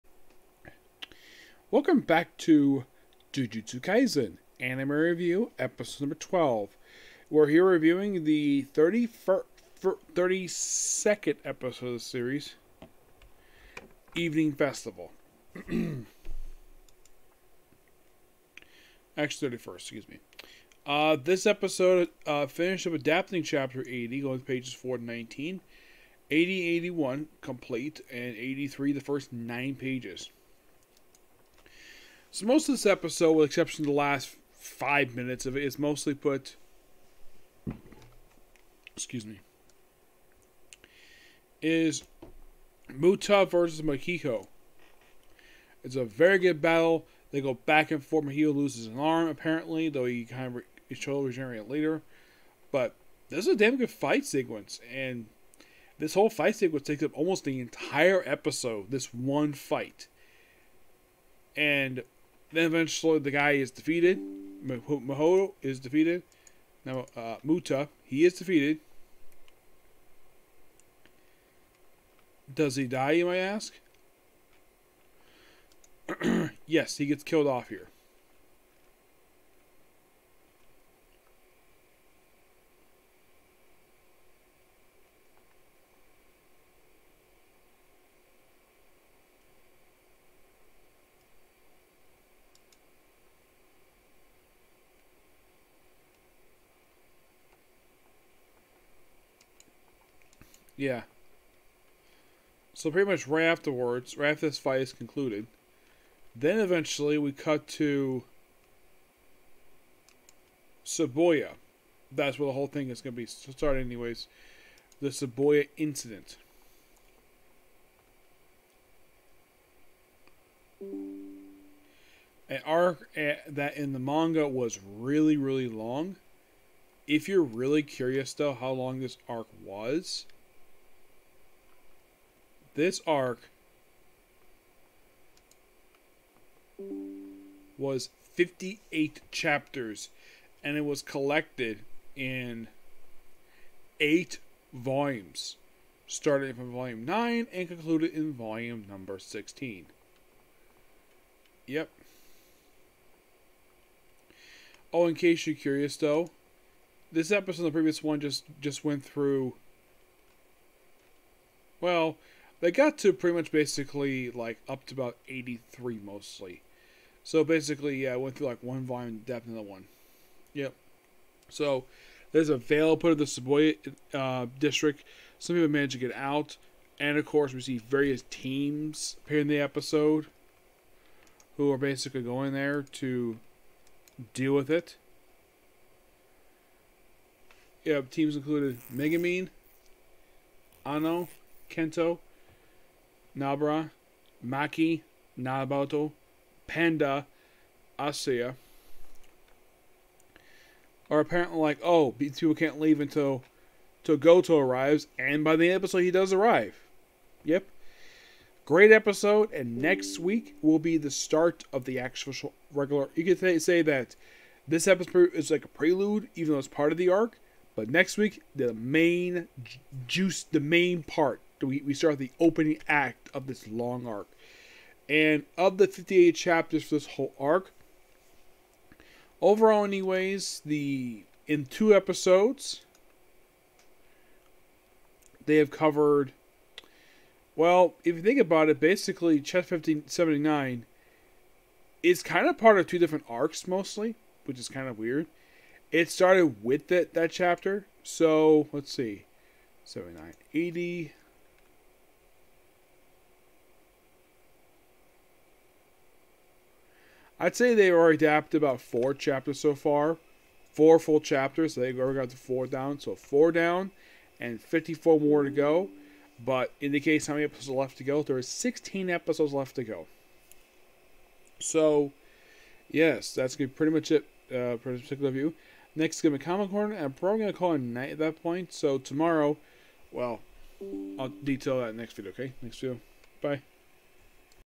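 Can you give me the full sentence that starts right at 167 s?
So basically, yeah, I went through like one volume depth in the one.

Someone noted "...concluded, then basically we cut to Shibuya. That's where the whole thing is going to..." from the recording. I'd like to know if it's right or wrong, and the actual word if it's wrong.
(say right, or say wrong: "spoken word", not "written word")
wrong: "eventually", not "basically".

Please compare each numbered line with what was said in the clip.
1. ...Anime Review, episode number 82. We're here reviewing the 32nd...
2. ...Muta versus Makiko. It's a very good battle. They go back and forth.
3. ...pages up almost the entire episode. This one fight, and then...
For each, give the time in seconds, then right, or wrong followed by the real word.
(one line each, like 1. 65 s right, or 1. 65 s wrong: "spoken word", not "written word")
1. 4 s wrong: "12", not "82"
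2. 42 s right
3. 56 s wrong: "takes", not "pages".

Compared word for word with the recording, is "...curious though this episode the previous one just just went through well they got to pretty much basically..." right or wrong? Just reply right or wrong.
right.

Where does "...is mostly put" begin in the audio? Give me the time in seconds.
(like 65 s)
35 s.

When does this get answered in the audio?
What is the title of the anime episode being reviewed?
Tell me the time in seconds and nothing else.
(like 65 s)
14 s.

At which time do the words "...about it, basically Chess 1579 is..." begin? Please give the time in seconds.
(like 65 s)
238 s.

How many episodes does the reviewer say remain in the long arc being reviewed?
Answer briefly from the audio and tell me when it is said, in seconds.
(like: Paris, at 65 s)
16, at 268 s.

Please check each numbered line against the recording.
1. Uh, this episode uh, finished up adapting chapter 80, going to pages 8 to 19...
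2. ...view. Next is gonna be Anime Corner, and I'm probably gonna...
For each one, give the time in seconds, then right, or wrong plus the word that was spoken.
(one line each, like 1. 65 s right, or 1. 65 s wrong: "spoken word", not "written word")
1. 20 s wrong: "4", not "8"
2. 275 s wrong: "Comic", not "Anime".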